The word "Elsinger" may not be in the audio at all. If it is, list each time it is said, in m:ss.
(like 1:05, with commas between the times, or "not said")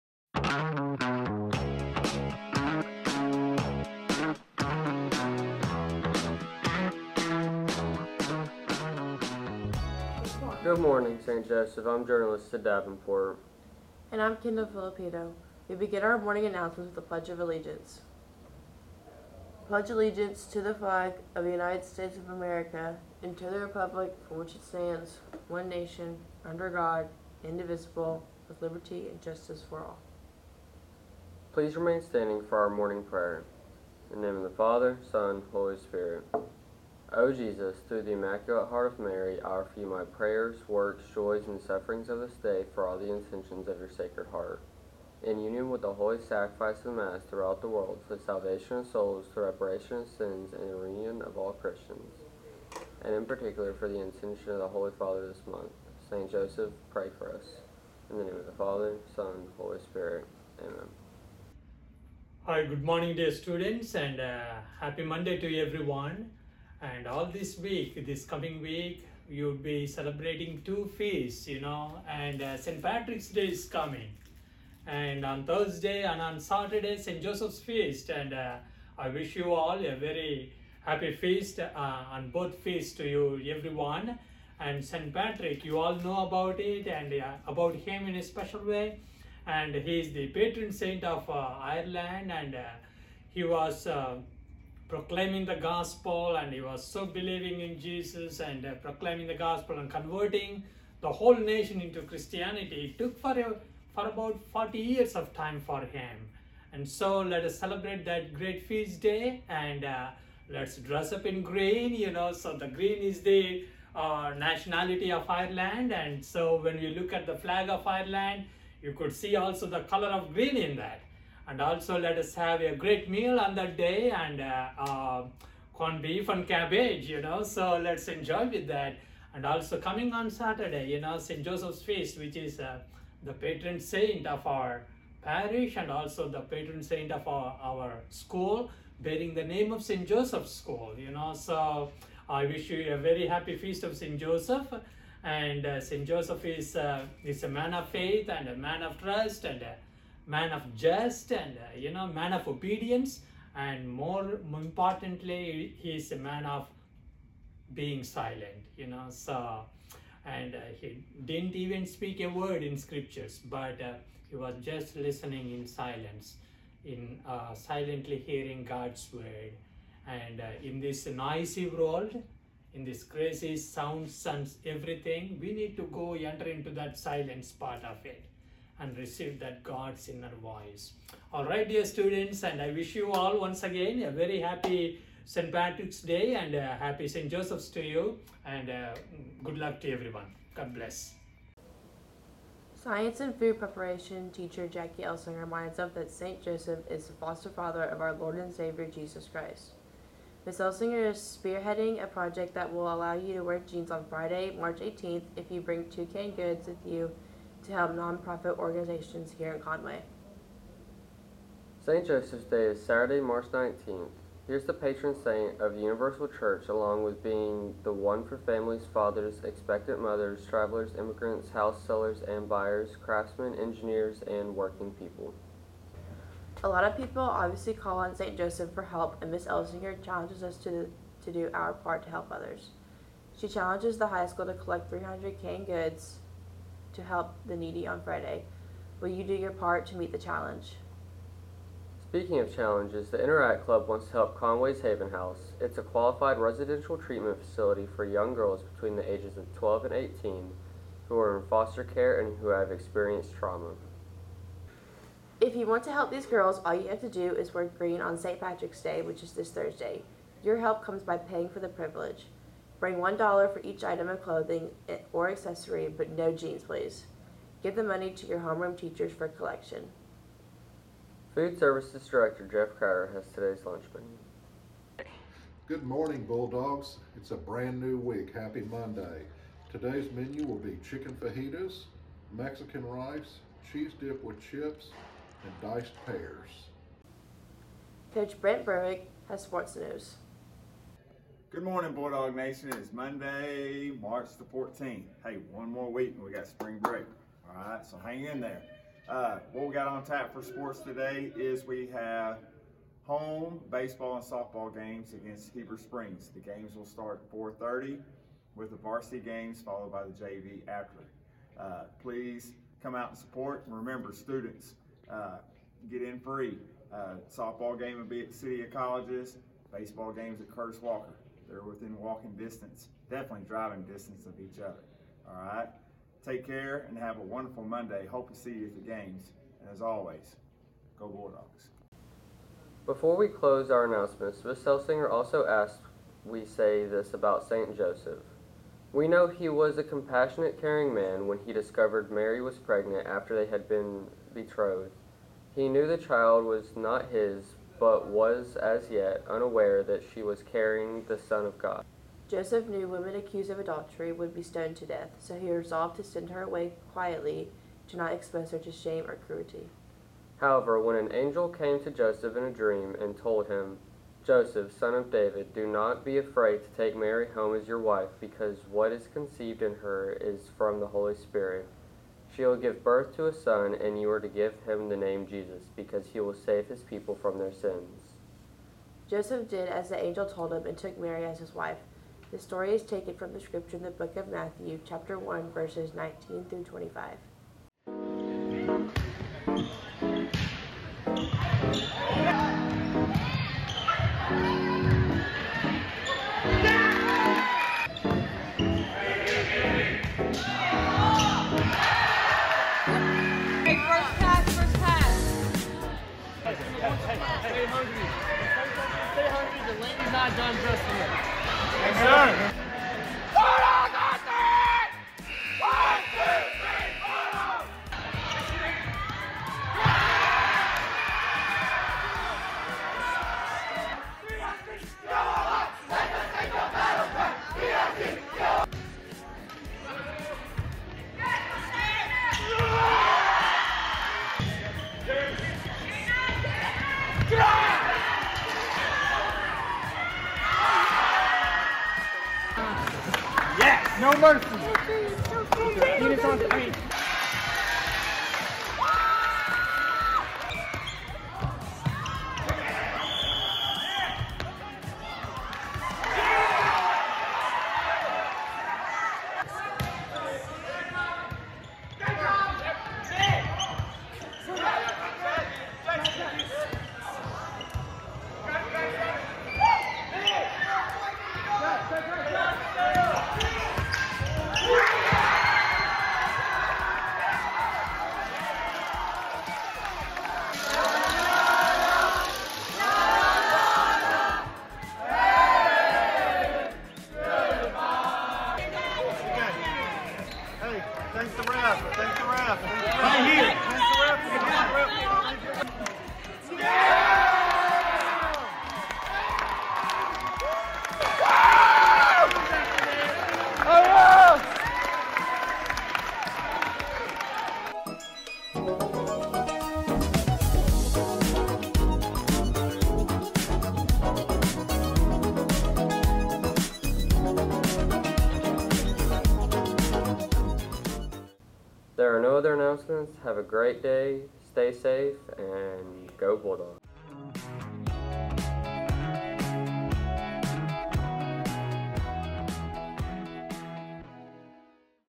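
3:20, 3:49, 5:34.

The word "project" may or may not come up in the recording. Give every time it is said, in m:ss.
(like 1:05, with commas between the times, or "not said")
3:22.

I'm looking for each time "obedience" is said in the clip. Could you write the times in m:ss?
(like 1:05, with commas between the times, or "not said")
2:32.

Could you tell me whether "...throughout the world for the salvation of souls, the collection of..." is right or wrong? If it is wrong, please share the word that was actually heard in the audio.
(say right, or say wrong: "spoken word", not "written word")
wrong: "reparation", not "collection".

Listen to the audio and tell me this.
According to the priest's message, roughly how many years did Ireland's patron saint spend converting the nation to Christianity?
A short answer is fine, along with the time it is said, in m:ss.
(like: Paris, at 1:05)
40, at 1:44.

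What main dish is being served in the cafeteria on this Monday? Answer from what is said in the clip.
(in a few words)
Chicken fajitas.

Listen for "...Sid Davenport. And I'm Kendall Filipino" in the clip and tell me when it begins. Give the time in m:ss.
0:12.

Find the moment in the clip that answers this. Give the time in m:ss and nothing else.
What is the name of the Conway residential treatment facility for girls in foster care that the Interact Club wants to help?
4:04.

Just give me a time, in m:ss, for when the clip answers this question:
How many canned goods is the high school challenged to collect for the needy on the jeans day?
3:54.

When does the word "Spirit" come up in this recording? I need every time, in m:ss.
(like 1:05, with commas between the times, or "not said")
0:35, 0:59, 6:11.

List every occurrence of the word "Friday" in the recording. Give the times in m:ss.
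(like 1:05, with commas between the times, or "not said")
3:24, 3:58.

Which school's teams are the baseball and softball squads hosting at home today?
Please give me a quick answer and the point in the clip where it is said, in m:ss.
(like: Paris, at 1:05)
Heber Springs, at 5:05.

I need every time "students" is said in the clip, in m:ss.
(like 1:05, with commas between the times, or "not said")
1:03, 3:01, 5:14.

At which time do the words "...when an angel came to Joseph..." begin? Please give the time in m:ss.
6:00.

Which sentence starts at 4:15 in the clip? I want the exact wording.
If you want to help these girls, all you have to do is wear green on St.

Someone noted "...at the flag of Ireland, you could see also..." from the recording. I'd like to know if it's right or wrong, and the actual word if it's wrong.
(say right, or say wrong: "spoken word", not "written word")
right.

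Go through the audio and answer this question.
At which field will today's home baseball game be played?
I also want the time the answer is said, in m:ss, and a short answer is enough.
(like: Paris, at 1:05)
Curtis Walker, at 5:20.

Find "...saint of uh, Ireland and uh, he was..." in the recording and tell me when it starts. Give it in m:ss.
1:30.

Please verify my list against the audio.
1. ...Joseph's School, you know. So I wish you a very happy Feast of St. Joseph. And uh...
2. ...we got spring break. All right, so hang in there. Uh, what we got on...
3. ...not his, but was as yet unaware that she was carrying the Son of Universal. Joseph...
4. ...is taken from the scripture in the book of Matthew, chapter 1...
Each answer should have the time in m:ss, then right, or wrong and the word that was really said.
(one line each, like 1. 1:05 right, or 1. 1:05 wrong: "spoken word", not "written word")
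1. 2:20 right
2. 4:56 right
3. 5:46 wrong: "God", not "Universal"
4. 6:22 right.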